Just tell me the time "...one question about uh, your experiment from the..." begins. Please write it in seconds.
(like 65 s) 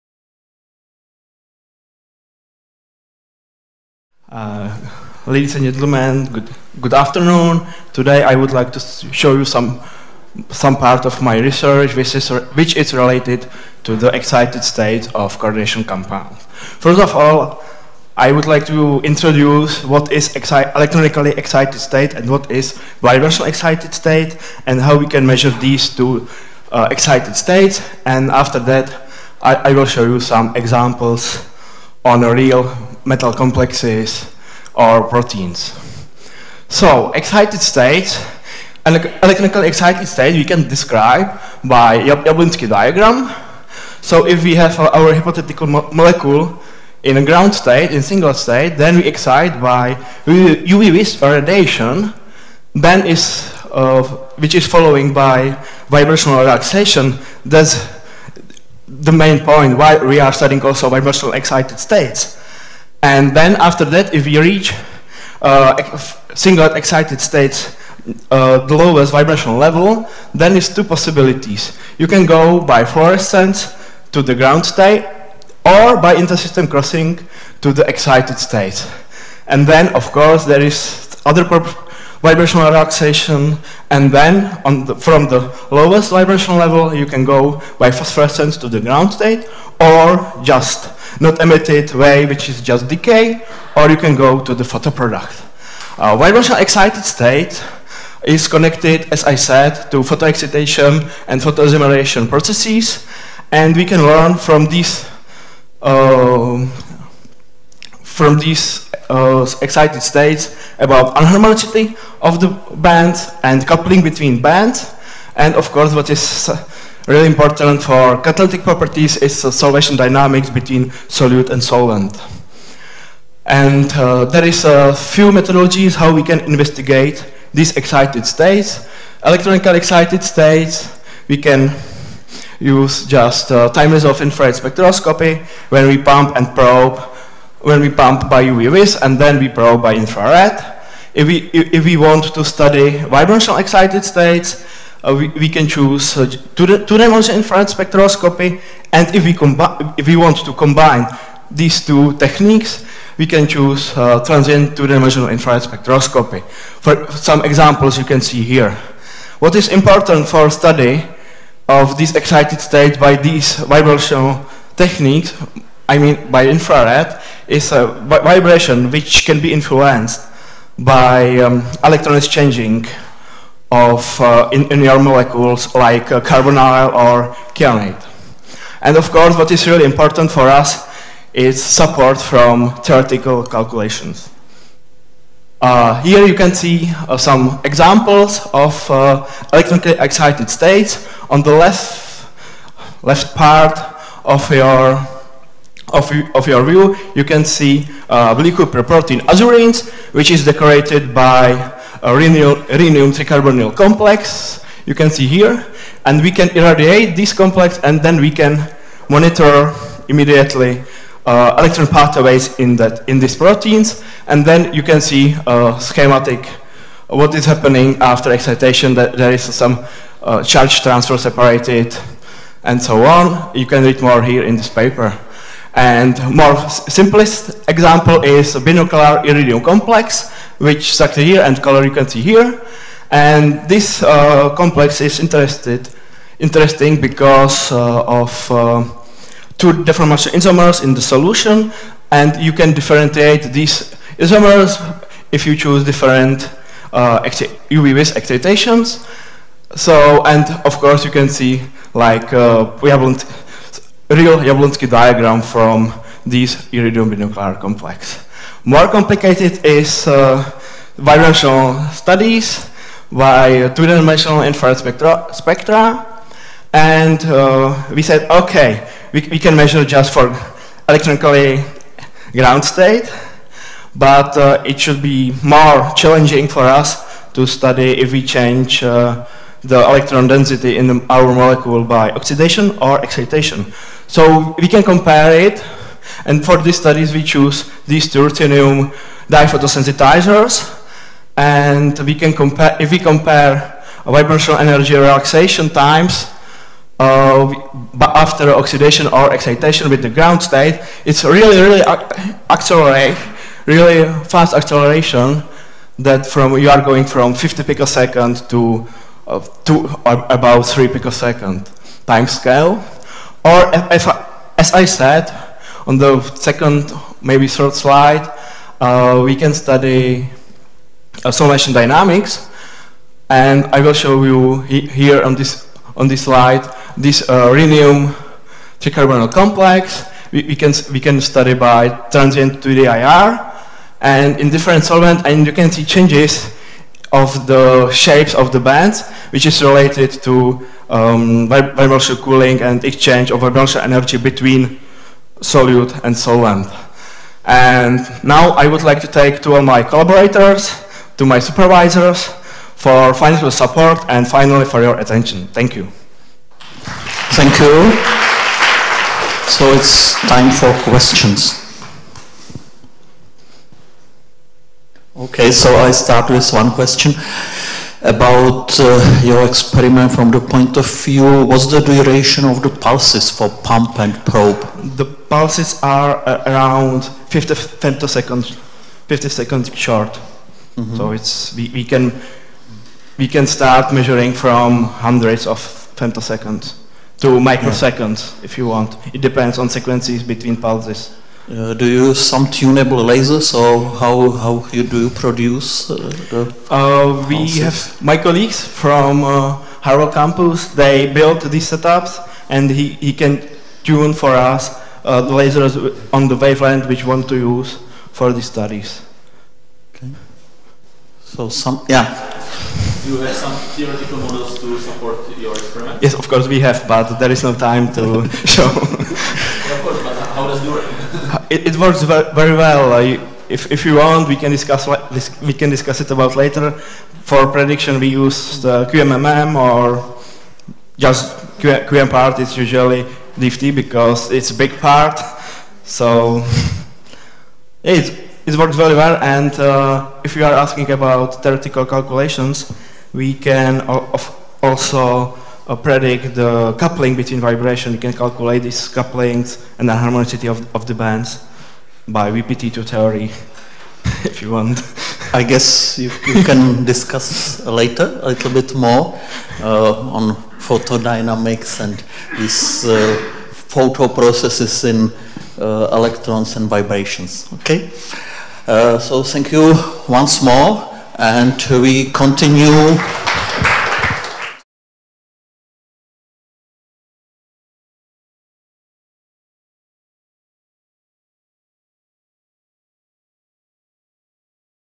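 366 s.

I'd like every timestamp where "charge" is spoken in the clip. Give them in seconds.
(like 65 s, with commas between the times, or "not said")
220 s.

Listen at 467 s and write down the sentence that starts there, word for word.
Okay, uh, so thank you once more, and we continue.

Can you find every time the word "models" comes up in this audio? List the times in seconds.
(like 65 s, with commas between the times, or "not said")
414 s.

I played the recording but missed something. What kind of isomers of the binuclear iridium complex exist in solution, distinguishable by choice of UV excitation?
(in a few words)
deformation isomers.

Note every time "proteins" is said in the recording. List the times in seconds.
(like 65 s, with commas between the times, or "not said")
35 s, 198 s, 213 s.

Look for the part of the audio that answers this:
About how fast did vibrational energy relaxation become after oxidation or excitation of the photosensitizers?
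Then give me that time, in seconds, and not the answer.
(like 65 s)
310 s.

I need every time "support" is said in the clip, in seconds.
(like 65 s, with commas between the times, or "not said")
181 s, 353 s, 414 s.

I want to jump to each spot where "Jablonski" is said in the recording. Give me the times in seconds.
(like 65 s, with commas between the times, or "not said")
41 s, 254 s.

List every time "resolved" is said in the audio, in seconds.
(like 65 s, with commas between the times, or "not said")
133 s.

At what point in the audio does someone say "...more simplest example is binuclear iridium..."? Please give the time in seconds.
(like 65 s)
226 s.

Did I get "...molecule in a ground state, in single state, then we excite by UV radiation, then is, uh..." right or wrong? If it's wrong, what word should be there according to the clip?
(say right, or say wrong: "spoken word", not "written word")
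right.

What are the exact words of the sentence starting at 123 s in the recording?
And uh, there is a few methodologies how we can investigate these excited states.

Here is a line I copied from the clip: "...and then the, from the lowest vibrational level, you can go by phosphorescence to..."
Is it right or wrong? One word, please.
right.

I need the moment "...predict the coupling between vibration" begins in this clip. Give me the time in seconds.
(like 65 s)
445 s.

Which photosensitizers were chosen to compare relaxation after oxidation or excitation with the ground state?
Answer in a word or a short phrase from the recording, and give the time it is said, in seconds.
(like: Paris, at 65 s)
titanium diphotosensitizers, at 288 s.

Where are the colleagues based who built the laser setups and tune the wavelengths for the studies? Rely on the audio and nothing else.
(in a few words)
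Harwell campus.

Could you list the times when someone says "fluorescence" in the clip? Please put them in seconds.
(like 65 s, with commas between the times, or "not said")
72 s.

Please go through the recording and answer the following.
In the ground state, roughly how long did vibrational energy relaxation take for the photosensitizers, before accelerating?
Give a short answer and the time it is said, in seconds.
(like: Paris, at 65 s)
50 picoseconds, at 307 s.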